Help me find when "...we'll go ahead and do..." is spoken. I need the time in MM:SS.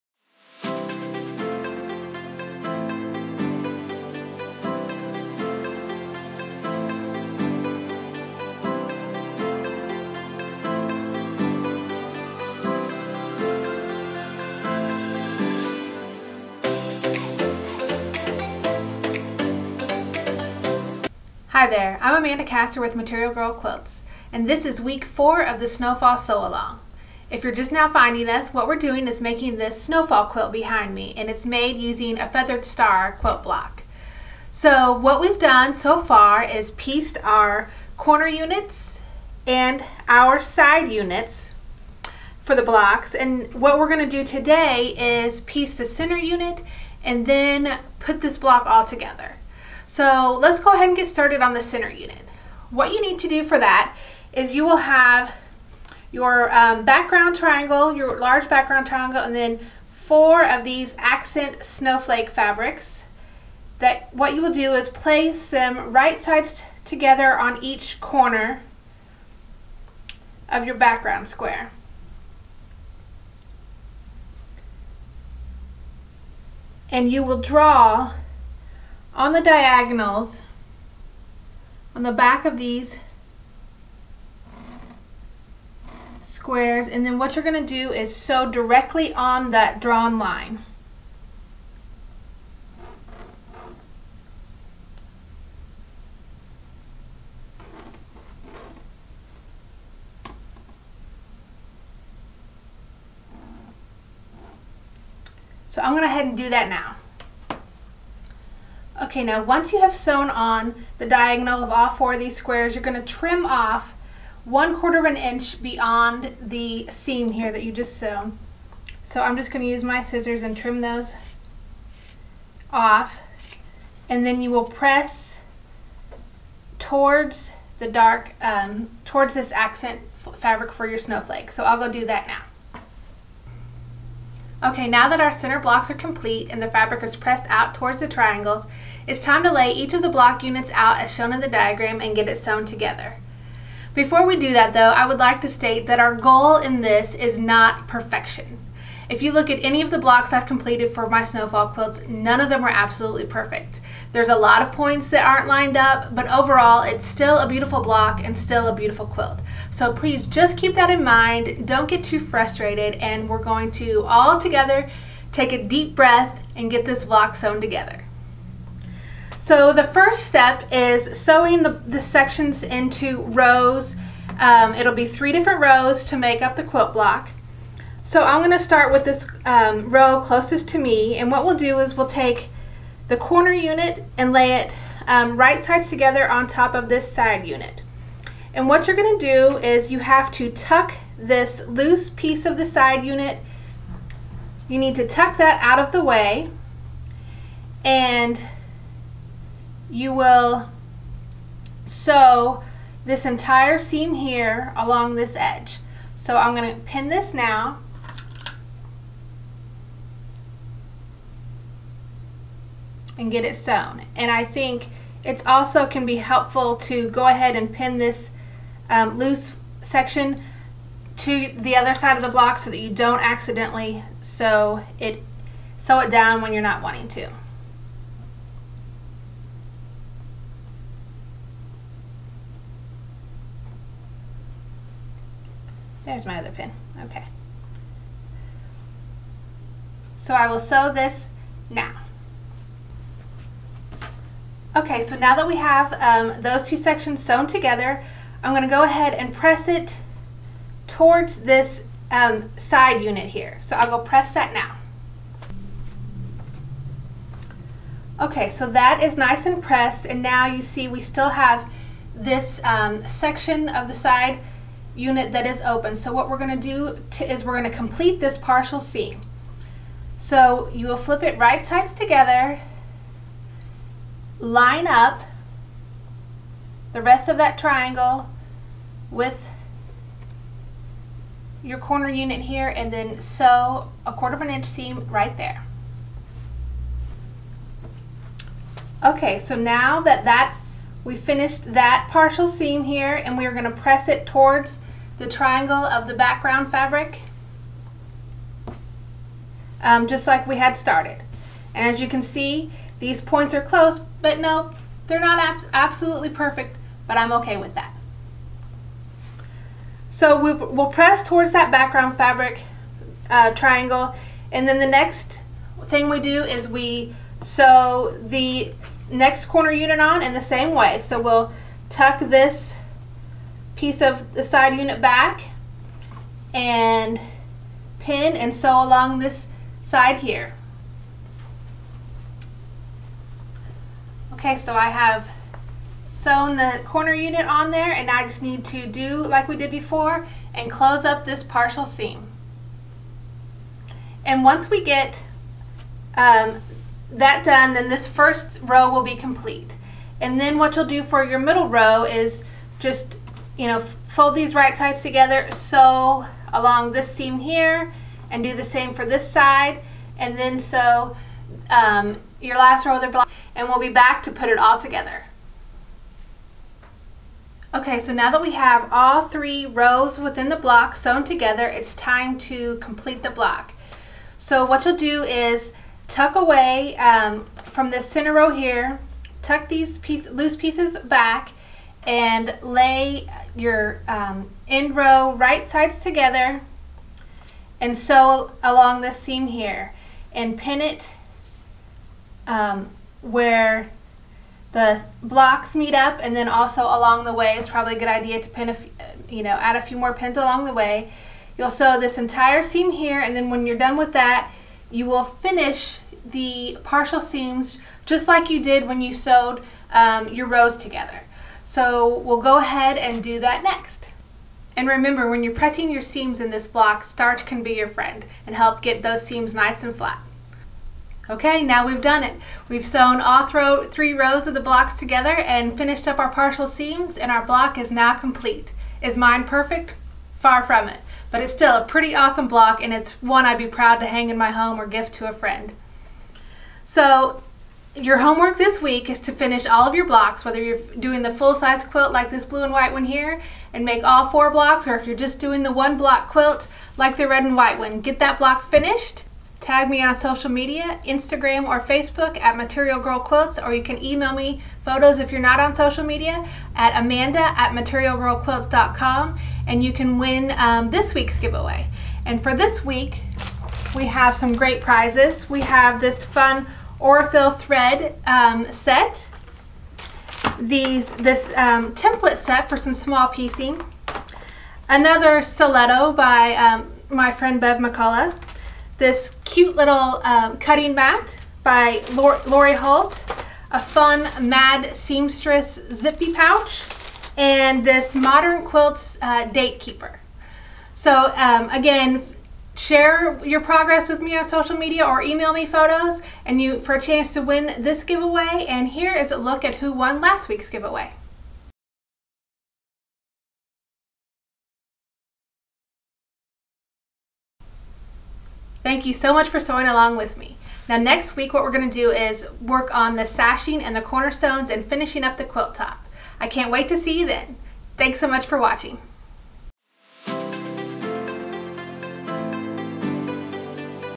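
06:52.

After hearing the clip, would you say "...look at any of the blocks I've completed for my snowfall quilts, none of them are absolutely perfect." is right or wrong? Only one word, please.
right.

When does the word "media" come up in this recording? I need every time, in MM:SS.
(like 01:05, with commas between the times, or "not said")
07:30, 07:36, 08:14.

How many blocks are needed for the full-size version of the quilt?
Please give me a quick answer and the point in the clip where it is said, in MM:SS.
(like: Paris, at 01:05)
4, at 07:23.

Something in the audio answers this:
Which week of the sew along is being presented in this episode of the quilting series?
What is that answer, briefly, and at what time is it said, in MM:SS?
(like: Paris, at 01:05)
week 4, at 00:24.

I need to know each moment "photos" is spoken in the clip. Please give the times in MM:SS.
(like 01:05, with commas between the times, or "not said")
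07:34, 08:15.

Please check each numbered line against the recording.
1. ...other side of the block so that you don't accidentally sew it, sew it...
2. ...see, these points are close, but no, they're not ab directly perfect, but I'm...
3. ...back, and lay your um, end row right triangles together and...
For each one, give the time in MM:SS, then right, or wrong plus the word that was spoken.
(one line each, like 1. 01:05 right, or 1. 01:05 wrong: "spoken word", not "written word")
1. 03:41 right
2. 05:02 wrong: "absolutely", not "directly"
3. 06:21 wrong: "sides", not "triangles".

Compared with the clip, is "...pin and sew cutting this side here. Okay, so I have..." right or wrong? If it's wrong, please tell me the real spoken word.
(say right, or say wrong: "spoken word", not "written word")
wrong: "along", not "cutting".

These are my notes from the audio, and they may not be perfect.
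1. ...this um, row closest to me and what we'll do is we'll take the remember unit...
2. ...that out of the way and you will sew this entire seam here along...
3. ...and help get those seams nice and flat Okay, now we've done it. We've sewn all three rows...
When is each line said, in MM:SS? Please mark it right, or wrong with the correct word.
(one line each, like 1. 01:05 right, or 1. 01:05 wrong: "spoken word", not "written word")
1. 02:59 wrong: "corner", not "remember"
2. 03:15 right
3. 06:58 right.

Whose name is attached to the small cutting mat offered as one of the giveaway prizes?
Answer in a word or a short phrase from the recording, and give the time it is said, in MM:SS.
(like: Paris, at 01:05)
Lori Holt, at 08:02.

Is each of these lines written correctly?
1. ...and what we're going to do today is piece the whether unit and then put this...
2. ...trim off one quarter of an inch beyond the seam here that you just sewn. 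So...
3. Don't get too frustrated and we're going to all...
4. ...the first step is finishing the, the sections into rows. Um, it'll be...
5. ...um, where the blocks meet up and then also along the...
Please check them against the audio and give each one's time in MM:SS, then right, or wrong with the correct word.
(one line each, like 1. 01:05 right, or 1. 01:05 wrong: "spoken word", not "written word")
1. 00:43 wrong: "center", not "whether"
2. 01:53 right
3. 02:41 right
4. 02:49 wrong: "sewing", not "finishing"
5. 06:32 right.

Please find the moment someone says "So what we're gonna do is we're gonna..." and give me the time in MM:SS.
04:25.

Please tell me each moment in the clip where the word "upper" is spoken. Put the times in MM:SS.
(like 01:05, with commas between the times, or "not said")
not said.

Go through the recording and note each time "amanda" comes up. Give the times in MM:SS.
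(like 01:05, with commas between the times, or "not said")
00:22, 07:36.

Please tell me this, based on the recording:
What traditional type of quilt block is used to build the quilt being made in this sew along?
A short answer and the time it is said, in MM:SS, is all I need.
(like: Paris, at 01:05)
feathered star, at 00:32.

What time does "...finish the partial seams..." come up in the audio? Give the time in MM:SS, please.
06:45.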